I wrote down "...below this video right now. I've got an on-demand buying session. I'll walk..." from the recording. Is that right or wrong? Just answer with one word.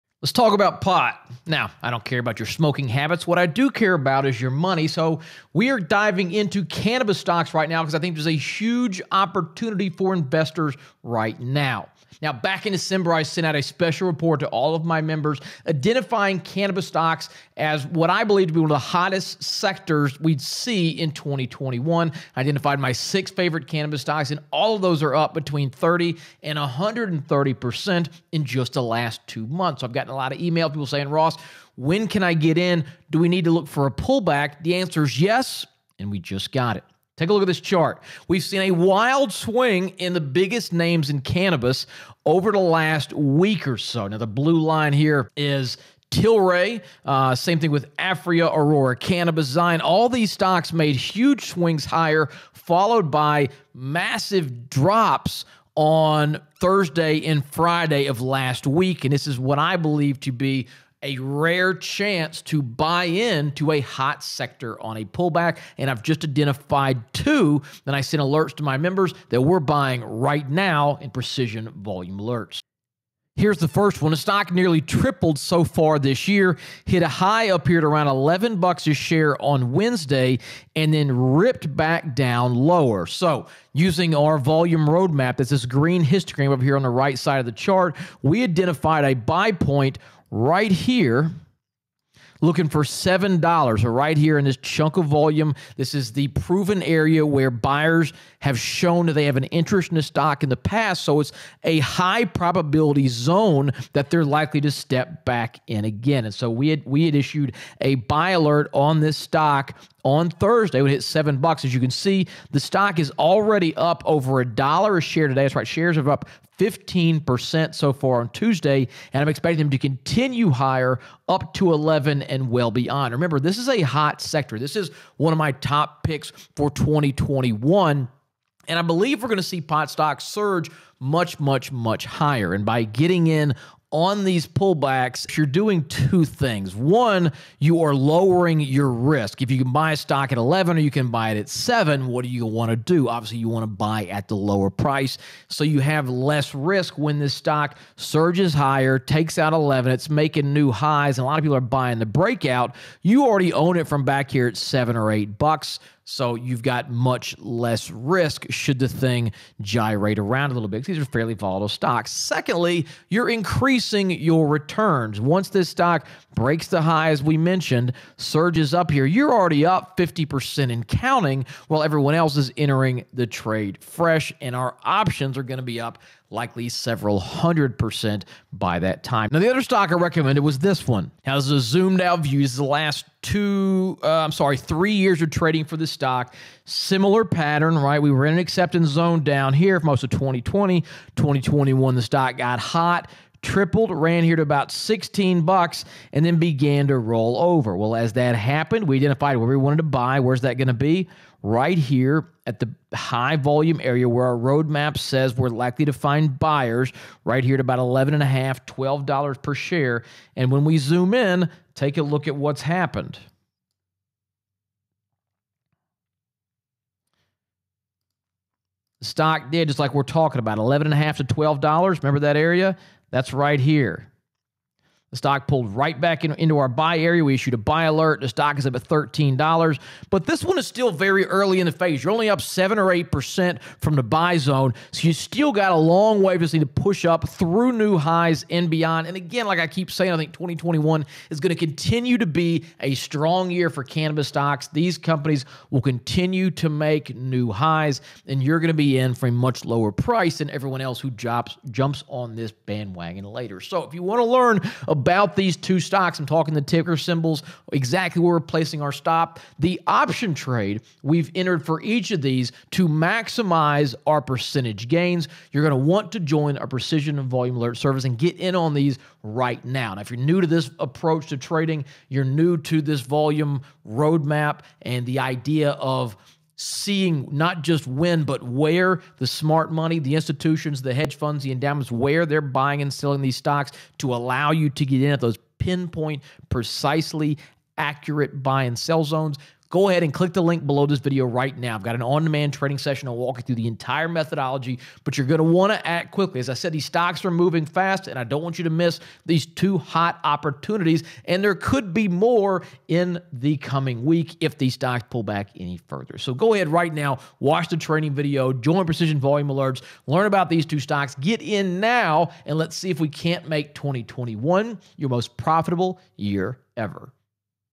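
wrong.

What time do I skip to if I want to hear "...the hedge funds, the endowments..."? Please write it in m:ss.
4:40.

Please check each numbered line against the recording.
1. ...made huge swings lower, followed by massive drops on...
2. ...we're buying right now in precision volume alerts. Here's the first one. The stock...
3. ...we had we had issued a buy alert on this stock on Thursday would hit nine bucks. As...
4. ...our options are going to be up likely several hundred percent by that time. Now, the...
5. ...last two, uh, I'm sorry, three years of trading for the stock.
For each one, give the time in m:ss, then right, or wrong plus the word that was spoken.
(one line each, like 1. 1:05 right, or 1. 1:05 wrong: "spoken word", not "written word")
1. 0:50 wrong: "higher", not "lower"
2. 1:09 right
3. 1:46 wrong: "seven", not "nine"
4. 2:54 right
5. 3:02 right.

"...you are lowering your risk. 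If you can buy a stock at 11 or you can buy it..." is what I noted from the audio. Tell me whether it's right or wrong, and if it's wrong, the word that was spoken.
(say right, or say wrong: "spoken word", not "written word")
right.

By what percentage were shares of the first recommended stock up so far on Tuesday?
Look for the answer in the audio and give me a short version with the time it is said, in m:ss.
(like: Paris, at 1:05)
15%, at 1:56.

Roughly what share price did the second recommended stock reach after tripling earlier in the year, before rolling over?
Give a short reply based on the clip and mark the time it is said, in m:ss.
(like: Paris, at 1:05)
$16, at 3:14.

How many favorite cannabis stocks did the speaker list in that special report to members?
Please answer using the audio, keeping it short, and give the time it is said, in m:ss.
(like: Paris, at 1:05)
6, at 0:22.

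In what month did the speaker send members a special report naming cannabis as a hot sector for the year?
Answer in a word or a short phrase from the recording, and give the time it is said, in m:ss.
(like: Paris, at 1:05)
December, at 0:12.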